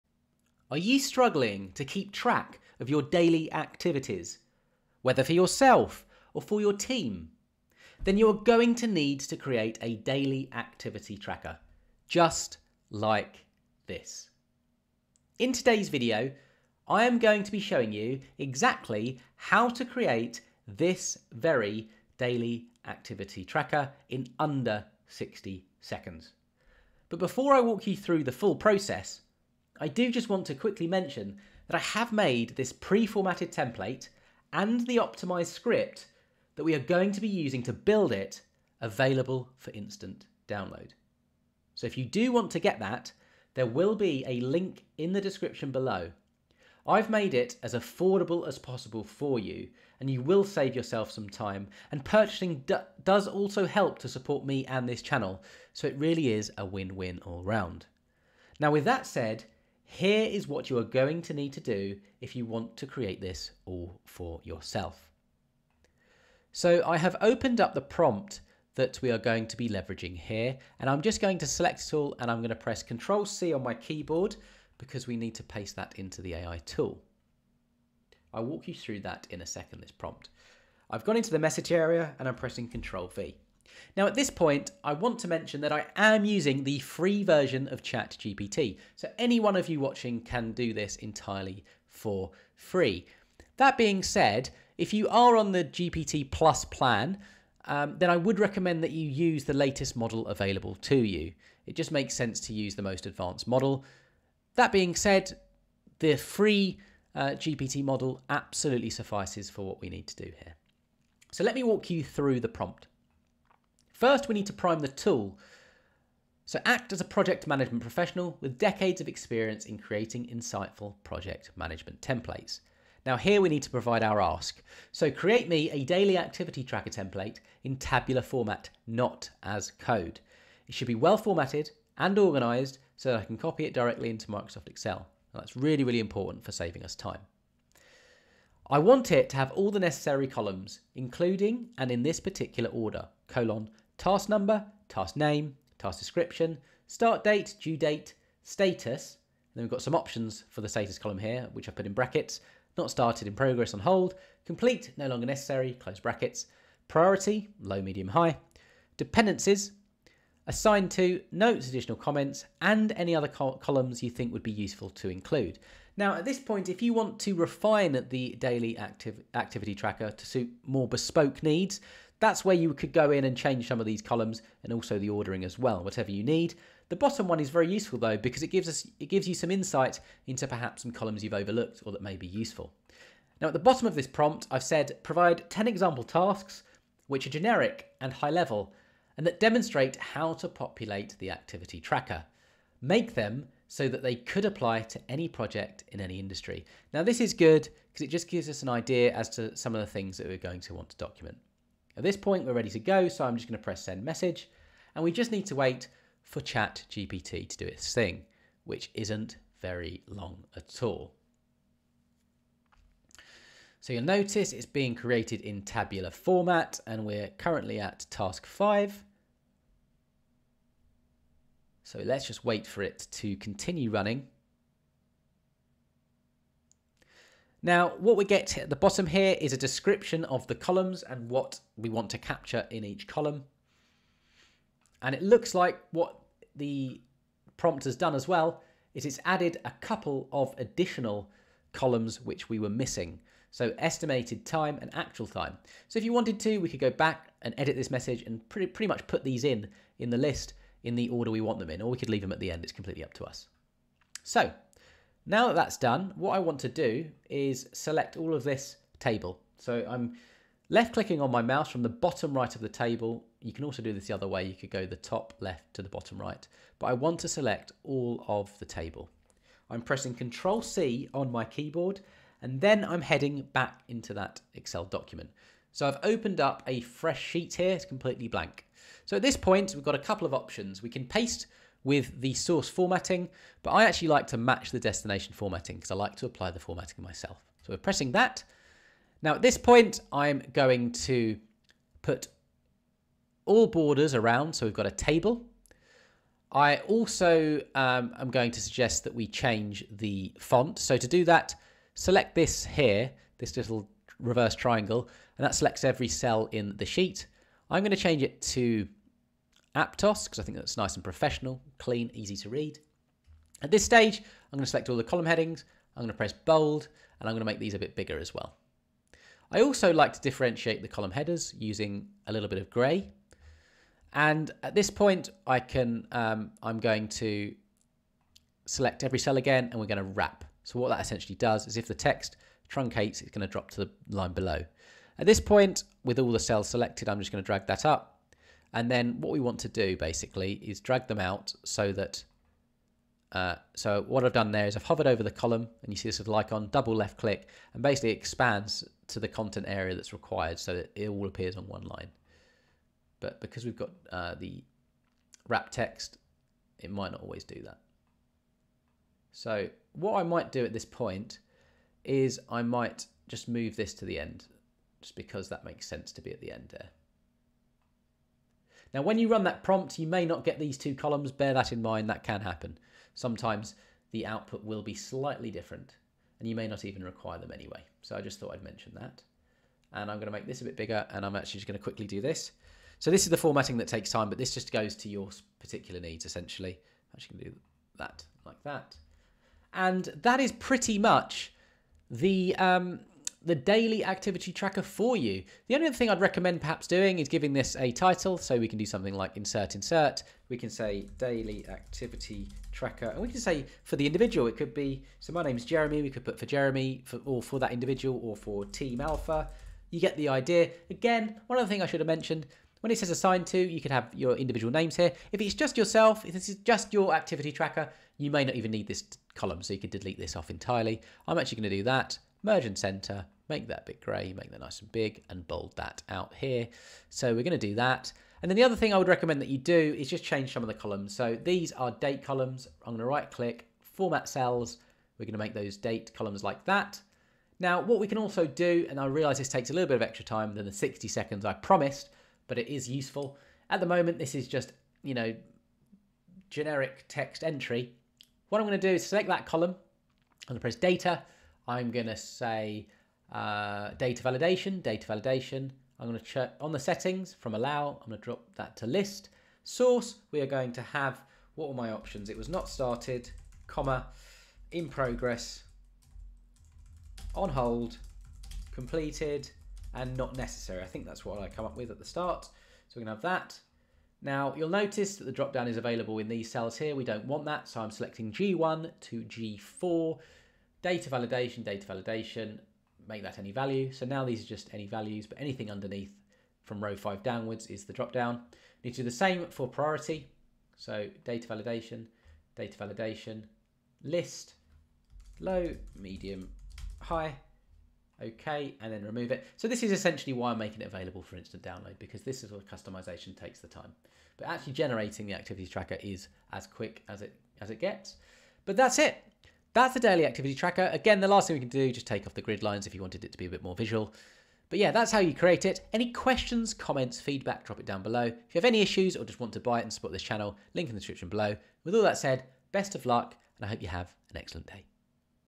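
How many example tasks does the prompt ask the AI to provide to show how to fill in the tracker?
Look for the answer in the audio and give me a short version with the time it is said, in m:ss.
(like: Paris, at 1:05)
10, at 3:05.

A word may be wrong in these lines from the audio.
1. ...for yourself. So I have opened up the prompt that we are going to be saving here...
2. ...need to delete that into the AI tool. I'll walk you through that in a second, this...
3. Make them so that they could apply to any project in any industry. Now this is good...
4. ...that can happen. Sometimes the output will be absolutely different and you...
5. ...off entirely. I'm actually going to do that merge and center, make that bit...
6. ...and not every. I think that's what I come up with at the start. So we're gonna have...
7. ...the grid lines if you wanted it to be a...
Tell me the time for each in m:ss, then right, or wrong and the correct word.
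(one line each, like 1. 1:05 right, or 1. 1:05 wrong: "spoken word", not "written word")
1. 1:04 wrong: "leveraging", not "saving"
2. 1:15 wrong: "paste", not "delete"
3. 3:12 right
4. 6:12 wrong: "slightly", not "absolutely"
5. 7:00 right
6. 7:49 wrong: "necessary", not "every"
7. 8:32 right.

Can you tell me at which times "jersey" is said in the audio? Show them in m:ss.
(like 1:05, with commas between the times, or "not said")
not said.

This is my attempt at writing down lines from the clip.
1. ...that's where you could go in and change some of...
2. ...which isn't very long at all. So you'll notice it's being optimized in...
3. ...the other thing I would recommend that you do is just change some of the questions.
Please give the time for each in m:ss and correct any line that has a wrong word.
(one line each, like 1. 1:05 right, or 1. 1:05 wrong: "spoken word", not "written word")
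1. 2:52 right
2. 3:28 wrong: "created", not "optimized"
3. 7:08 wrong: "columns", not "questions".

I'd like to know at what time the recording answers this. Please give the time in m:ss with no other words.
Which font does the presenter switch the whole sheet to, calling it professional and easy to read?
5:09.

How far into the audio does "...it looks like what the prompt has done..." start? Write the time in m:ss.
3:55.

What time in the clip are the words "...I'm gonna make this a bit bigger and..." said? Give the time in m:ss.
6:20.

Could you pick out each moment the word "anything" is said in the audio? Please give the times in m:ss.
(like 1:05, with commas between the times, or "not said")
8:05.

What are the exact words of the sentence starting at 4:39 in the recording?
So at this point, we've got a couple of options.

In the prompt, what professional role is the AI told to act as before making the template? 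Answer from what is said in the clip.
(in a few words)
Project management professional.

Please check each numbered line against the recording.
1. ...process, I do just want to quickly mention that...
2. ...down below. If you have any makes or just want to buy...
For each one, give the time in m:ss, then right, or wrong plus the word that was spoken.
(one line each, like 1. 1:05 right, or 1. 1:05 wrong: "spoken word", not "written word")
1. 0:28 right
2. 8:37 wrong: "issues", not "makes".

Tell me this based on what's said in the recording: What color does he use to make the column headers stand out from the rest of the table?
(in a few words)
Grey.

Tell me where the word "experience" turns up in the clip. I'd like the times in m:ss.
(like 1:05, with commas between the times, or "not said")
1:59.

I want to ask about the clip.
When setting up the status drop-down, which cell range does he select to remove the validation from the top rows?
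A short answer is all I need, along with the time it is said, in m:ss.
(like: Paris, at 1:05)
G1 to G4, at 7:58.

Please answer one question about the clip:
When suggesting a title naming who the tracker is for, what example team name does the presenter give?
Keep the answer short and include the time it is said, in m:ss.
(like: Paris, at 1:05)
Team Alpha, at 6:48.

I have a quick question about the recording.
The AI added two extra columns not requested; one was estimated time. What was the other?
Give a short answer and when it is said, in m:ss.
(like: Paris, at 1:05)
Actual time, at 4:04.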